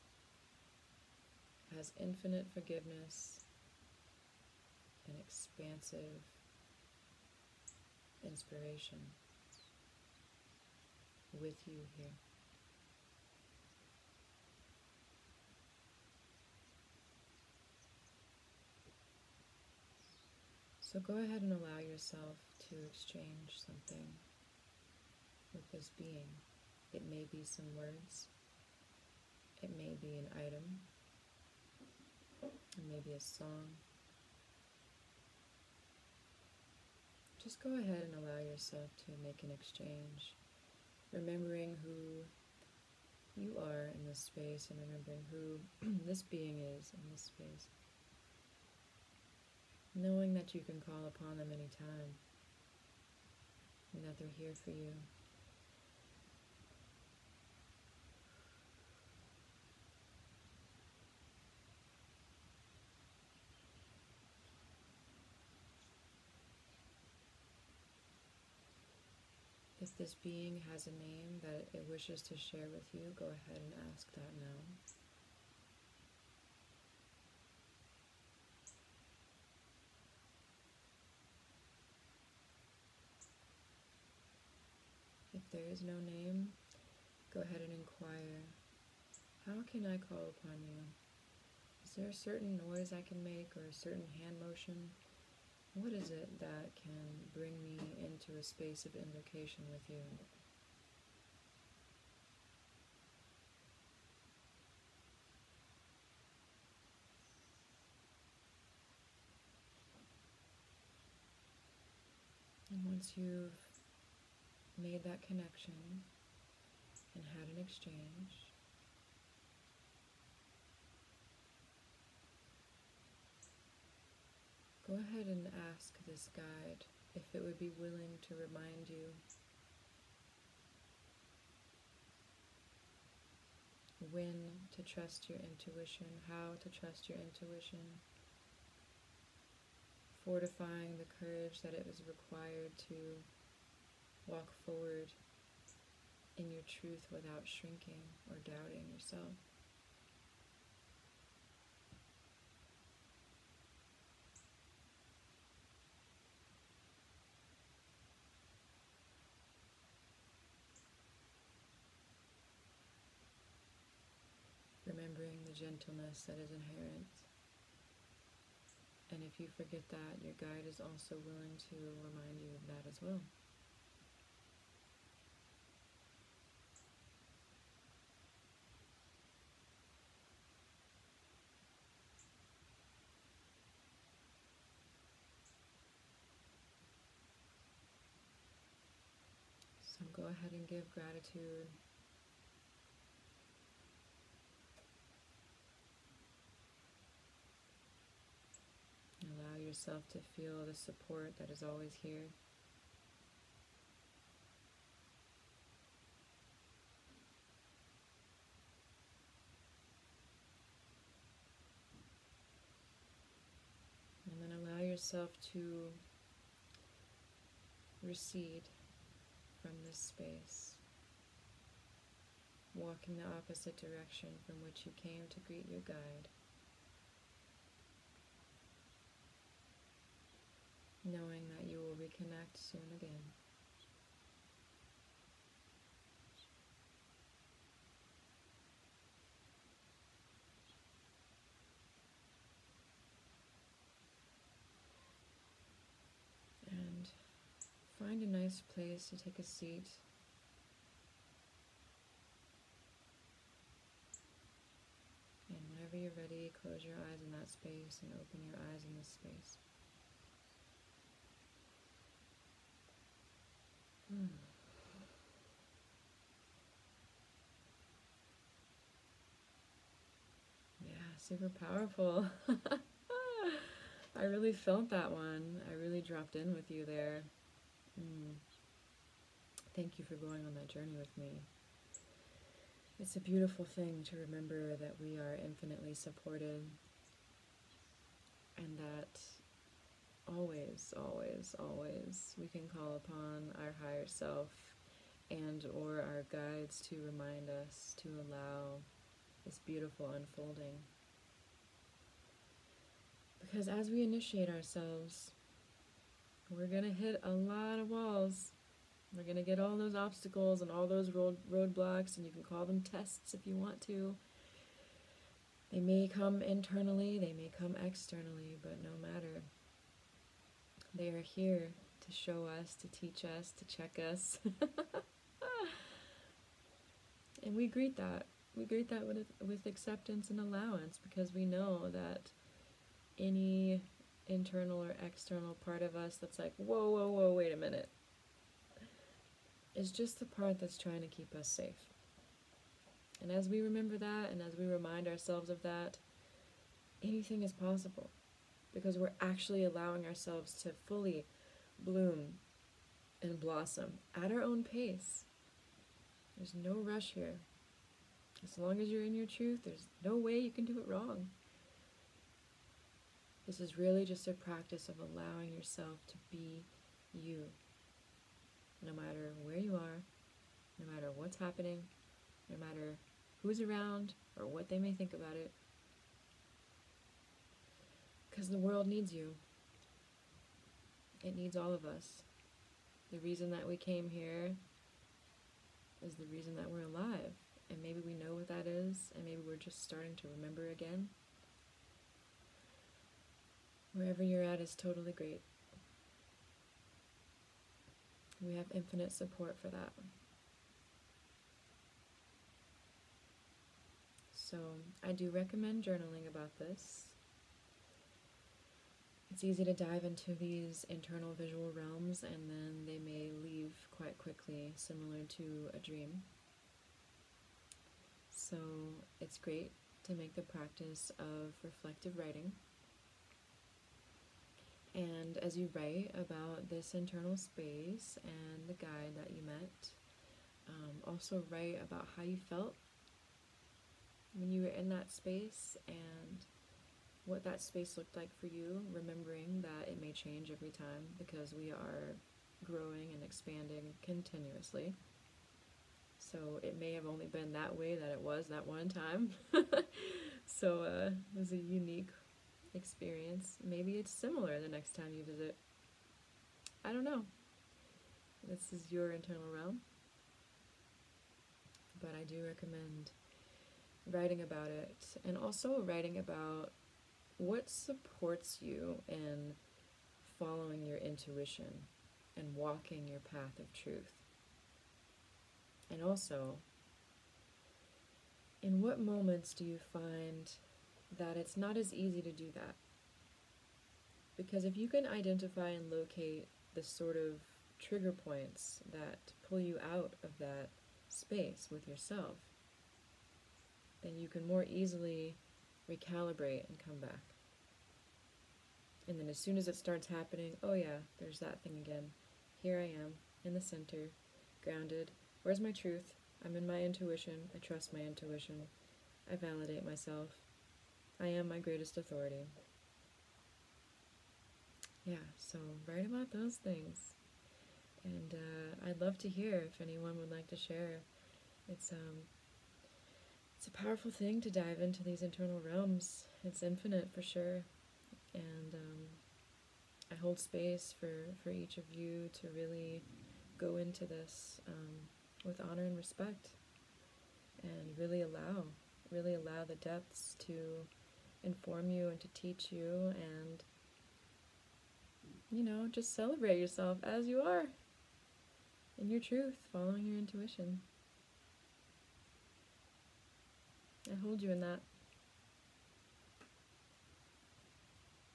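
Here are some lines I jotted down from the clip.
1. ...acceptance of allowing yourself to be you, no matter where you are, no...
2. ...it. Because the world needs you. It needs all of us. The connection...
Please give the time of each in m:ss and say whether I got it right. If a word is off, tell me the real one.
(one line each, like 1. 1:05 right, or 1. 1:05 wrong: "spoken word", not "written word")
1. 6:04 wrong: "practice", not "acceptance"
2. 6:15 wrong: "reason", not "connection".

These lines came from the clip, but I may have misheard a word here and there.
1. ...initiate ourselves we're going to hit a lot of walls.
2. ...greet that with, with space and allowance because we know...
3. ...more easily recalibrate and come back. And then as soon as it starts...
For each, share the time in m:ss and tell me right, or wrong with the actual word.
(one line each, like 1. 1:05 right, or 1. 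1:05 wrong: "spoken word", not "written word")
1. 5:04 right
2. 5:28 wrong: "acceptance", not "space"
3. 8:14 right.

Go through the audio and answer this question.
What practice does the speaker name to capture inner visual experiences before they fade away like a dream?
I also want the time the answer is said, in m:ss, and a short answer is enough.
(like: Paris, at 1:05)
Reflective writing, at 7:01.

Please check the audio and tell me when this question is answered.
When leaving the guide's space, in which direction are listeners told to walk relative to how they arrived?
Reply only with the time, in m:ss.
3:43.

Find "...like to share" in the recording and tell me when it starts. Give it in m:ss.
8:40.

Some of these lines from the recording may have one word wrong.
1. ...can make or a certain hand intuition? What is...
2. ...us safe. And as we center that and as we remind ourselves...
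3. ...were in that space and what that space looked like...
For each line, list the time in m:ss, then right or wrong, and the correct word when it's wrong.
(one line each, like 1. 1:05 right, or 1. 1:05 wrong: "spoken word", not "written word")
1. 1:33 wrong: "motion", not "intuition"
2. 5:41 wrong: "remember", not "center"
3. 7:14 right.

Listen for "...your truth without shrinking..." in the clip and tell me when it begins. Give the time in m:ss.
2:26.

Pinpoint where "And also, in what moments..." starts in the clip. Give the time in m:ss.
7:55.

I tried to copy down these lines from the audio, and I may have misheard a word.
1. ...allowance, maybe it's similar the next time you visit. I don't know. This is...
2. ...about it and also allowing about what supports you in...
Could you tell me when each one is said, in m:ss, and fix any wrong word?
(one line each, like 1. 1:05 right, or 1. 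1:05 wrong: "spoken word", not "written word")
1. 7:32 wrong: "experience", not "allowance"
2. 7:44 wrong: "writing", not "allowing".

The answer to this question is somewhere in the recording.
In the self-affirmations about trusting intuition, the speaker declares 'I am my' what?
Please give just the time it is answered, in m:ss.
8:31.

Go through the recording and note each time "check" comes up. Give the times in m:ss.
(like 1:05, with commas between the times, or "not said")
5:23.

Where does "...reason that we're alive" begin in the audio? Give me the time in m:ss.
6:26.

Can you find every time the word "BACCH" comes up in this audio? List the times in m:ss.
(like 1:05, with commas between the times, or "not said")
not said.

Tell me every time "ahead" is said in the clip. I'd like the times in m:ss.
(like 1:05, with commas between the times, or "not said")
0:21, 0:37, 1:13, 1:27, 2:04, 3:10.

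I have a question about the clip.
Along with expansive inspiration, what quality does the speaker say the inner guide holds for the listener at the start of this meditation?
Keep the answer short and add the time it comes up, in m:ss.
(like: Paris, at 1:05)
Infinite forgiveness, at 0:01.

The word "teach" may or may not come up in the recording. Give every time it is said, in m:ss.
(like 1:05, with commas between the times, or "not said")
5:22, 9:02.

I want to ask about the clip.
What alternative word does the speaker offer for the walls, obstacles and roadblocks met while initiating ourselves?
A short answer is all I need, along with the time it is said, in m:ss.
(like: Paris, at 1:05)
Tests, at 5:12.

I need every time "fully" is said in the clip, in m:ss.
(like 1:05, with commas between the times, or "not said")
5:50.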